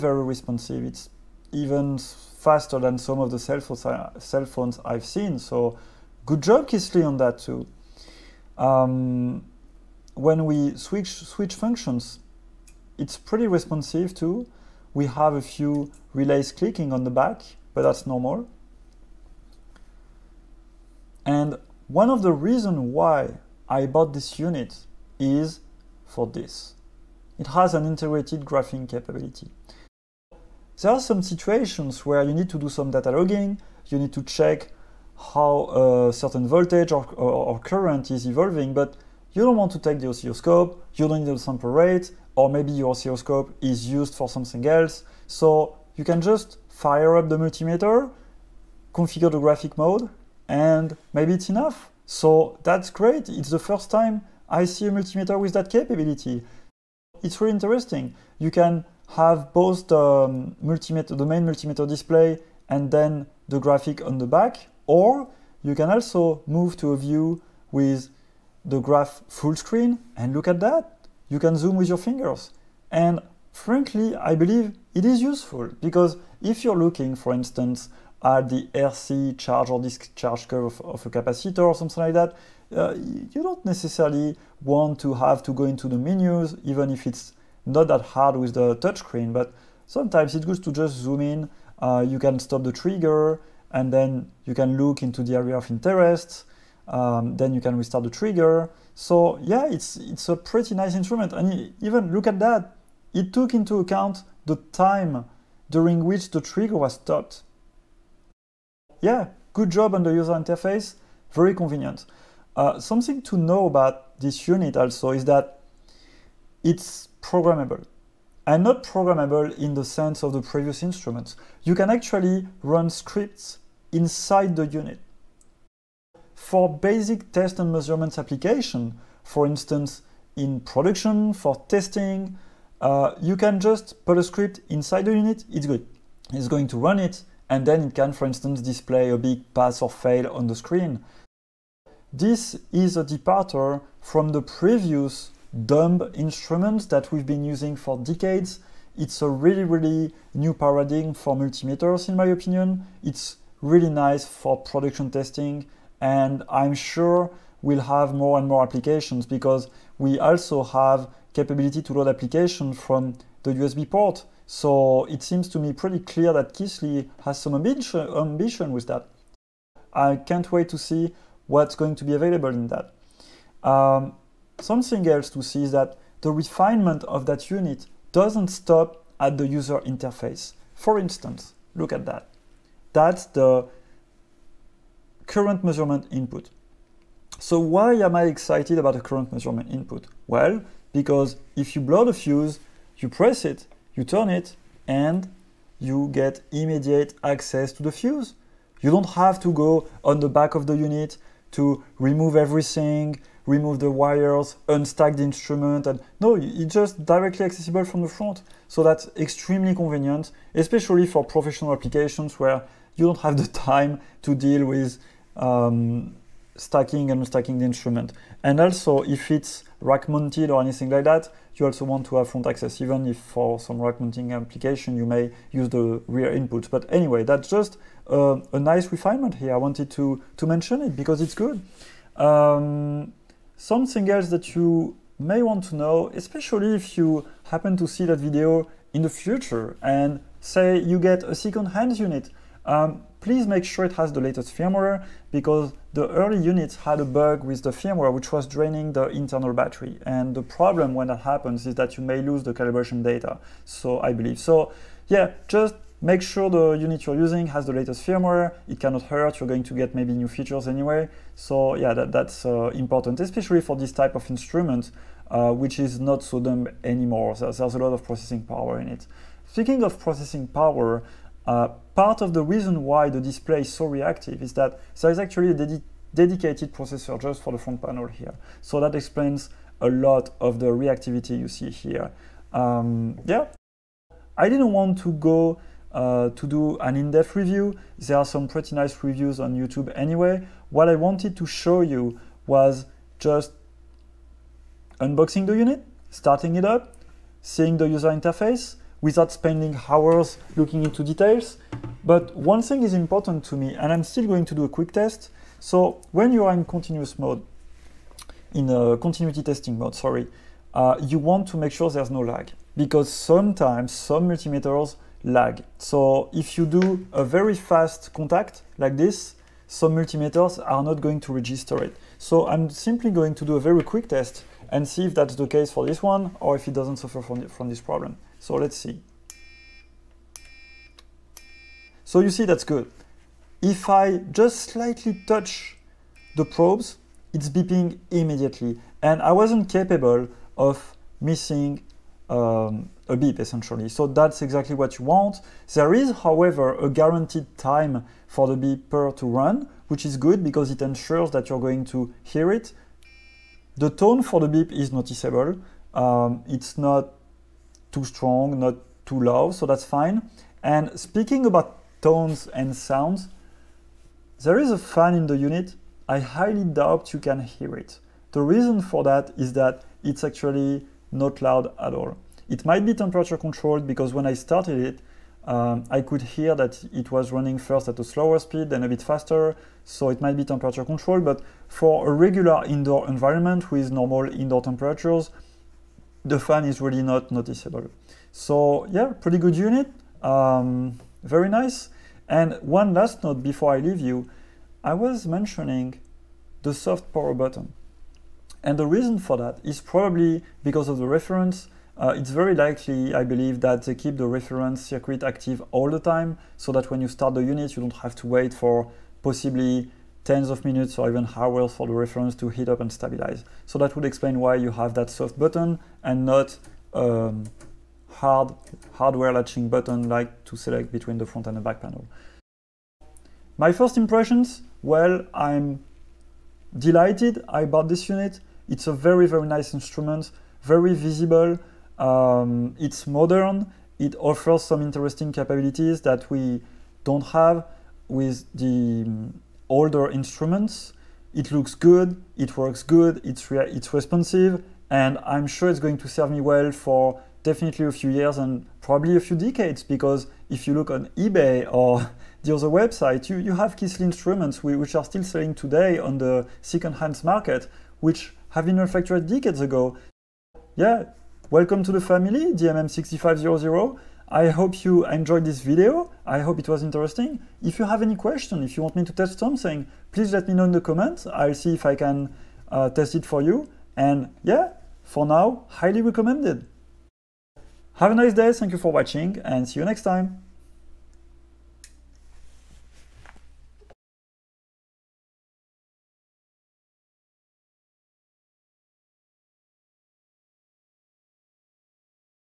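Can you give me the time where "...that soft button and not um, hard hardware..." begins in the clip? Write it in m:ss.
6:54.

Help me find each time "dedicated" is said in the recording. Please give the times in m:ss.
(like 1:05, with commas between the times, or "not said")
4:36.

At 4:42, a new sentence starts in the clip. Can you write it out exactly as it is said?
Um, yeah, I didn't want to go uh, to do an in-depth review.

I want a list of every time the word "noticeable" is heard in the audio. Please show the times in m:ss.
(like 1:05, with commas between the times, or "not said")
5:54, 6:27.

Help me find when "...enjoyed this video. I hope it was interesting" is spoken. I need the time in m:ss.
7:45.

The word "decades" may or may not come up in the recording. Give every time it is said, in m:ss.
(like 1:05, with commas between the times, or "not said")
2:27, 7:29, 7:39.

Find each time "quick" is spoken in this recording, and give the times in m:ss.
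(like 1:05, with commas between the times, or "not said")
5:04, 5:23.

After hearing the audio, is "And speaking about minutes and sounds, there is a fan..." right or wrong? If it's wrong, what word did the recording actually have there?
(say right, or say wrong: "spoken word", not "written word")
wrong: "tones", not "minutes".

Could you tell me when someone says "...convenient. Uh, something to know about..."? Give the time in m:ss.
1:51.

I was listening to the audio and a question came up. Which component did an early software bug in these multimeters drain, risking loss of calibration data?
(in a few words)
Internal battery.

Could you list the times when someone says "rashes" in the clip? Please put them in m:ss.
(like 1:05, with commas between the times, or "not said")
not said.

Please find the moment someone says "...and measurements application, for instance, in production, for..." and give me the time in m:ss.
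2:07.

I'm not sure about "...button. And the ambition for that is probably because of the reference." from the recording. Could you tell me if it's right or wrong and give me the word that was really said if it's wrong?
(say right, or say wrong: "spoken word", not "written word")
wrong: "reason", not "ambition".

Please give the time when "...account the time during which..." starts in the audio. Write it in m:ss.
1:43.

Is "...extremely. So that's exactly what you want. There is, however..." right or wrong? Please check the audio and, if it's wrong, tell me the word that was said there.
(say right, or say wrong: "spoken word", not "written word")
wrong: "essentially", not "extremely".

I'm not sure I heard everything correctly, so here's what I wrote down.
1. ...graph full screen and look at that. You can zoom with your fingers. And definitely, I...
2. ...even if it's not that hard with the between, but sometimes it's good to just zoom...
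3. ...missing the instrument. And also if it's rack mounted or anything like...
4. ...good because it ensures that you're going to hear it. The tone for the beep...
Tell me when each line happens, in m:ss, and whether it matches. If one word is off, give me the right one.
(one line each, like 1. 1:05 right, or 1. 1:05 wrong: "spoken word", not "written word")
1. 1:08 wrong: "frankly", not "definitely"
2. 1:26 wrong: "touchscreen", not "between"
3. 3:37 wrong: "unstacking", not "missing"
4. 5:50 right.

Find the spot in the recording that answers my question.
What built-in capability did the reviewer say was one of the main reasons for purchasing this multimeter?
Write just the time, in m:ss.
0:27.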